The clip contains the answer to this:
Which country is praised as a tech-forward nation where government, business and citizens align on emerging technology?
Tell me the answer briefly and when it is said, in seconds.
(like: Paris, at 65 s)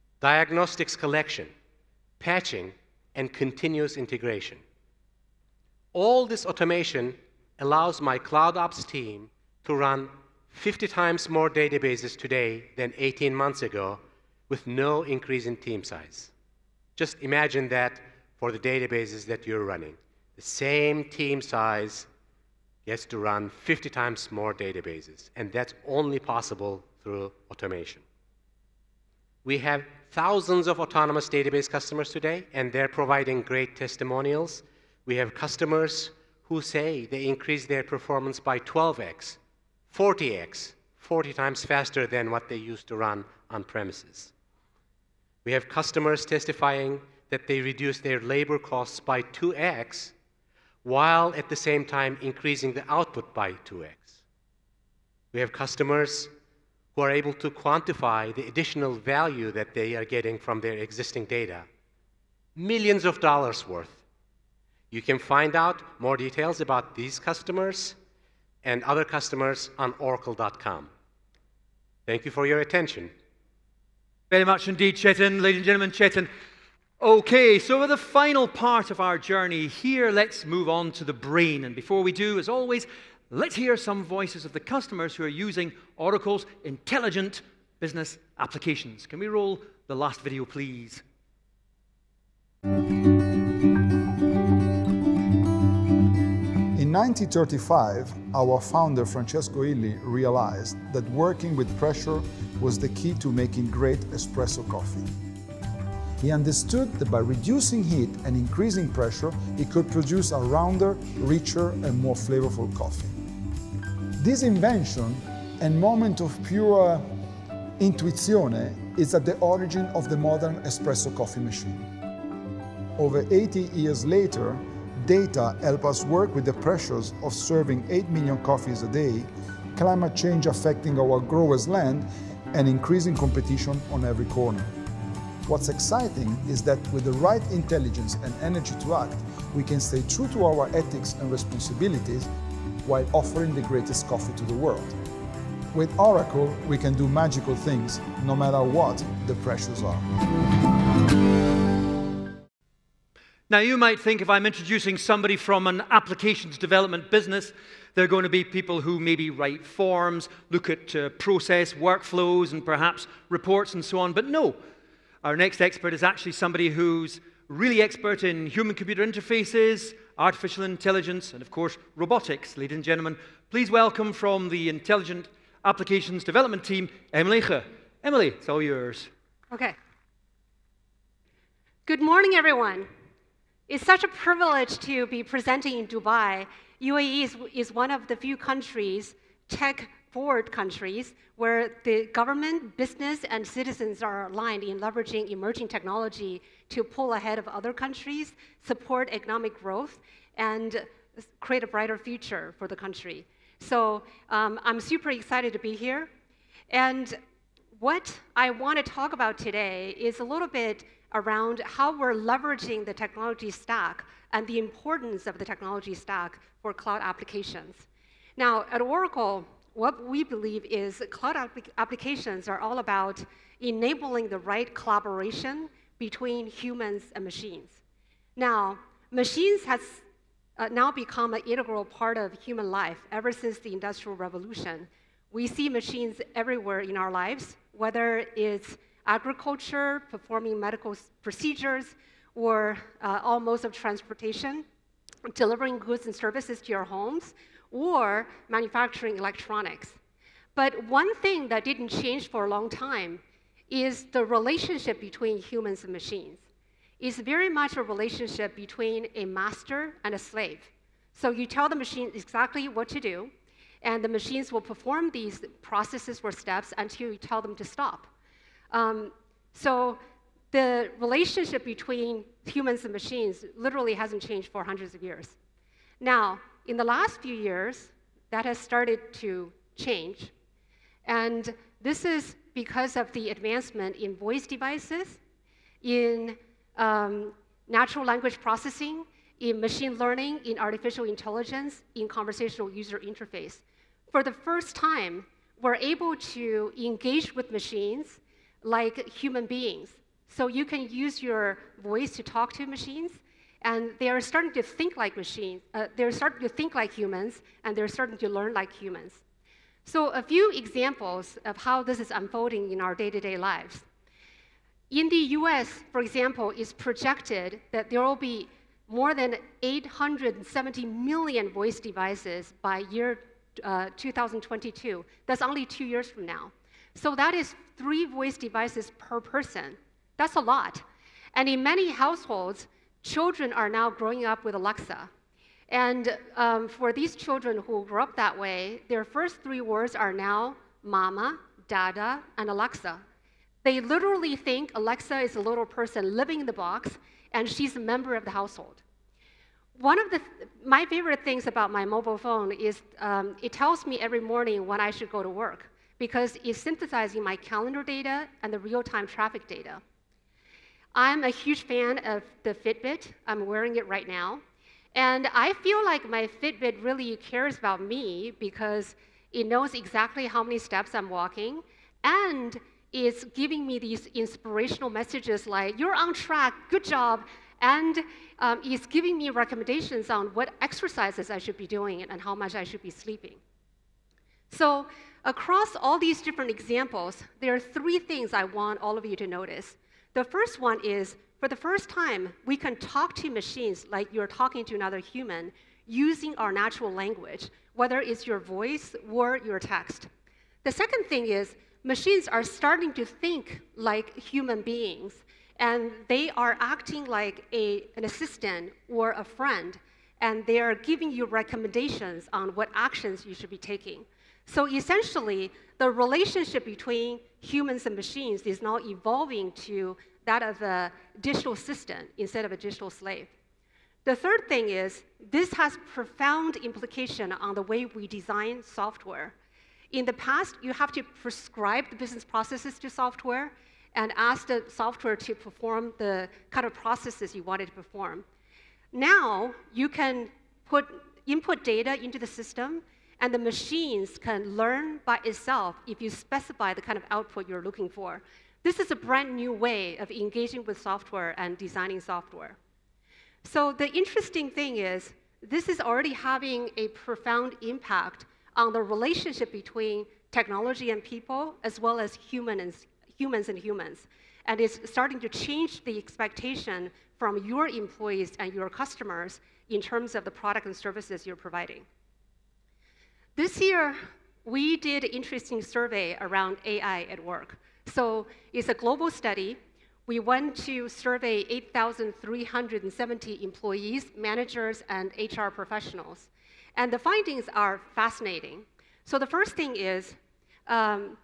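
UAE, at 186 s.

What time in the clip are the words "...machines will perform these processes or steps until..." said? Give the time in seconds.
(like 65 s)
264 s.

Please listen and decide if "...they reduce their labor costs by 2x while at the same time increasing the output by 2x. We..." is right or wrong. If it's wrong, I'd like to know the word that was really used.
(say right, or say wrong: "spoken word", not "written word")
right.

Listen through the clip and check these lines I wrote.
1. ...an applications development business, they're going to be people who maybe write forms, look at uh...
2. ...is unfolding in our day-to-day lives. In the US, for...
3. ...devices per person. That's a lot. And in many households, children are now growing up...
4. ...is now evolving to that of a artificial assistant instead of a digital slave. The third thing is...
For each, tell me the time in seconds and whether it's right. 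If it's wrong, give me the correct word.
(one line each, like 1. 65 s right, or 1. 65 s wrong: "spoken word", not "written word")
1. 155 s right
2. 312 s right
3. 328 s right
4. 418 s wrong: "digital", not "artificial".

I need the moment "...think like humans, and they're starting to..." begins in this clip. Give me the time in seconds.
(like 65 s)
306 s.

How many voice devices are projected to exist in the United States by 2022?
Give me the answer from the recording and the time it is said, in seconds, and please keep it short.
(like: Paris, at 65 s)
870 million, at 319 s.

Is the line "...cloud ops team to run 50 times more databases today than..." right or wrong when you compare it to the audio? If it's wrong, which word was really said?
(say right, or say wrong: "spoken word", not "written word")
right.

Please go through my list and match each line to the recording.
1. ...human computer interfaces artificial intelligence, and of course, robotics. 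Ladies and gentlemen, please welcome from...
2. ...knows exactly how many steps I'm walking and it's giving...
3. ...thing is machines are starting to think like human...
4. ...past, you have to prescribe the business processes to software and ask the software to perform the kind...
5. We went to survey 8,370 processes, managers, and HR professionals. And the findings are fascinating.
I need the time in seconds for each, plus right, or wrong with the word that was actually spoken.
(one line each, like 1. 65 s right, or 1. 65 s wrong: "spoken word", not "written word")
1. 168 s right
2. 369 s right
3. 401 s right
4. 430 s right
5. 480 s wrong: "employees", not "processes".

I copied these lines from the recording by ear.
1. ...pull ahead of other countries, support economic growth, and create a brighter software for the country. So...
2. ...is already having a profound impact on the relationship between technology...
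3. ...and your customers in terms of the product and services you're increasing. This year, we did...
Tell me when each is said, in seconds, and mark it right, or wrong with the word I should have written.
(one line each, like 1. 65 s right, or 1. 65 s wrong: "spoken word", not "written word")
1. 196 s wrong: "future", not "software"
2. 455 s right
3. 468 s wrong: "providing", not "increasing".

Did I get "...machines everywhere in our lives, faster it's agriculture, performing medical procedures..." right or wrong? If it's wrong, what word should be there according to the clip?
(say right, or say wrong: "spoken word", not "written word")
wrong: "whether", not "faster".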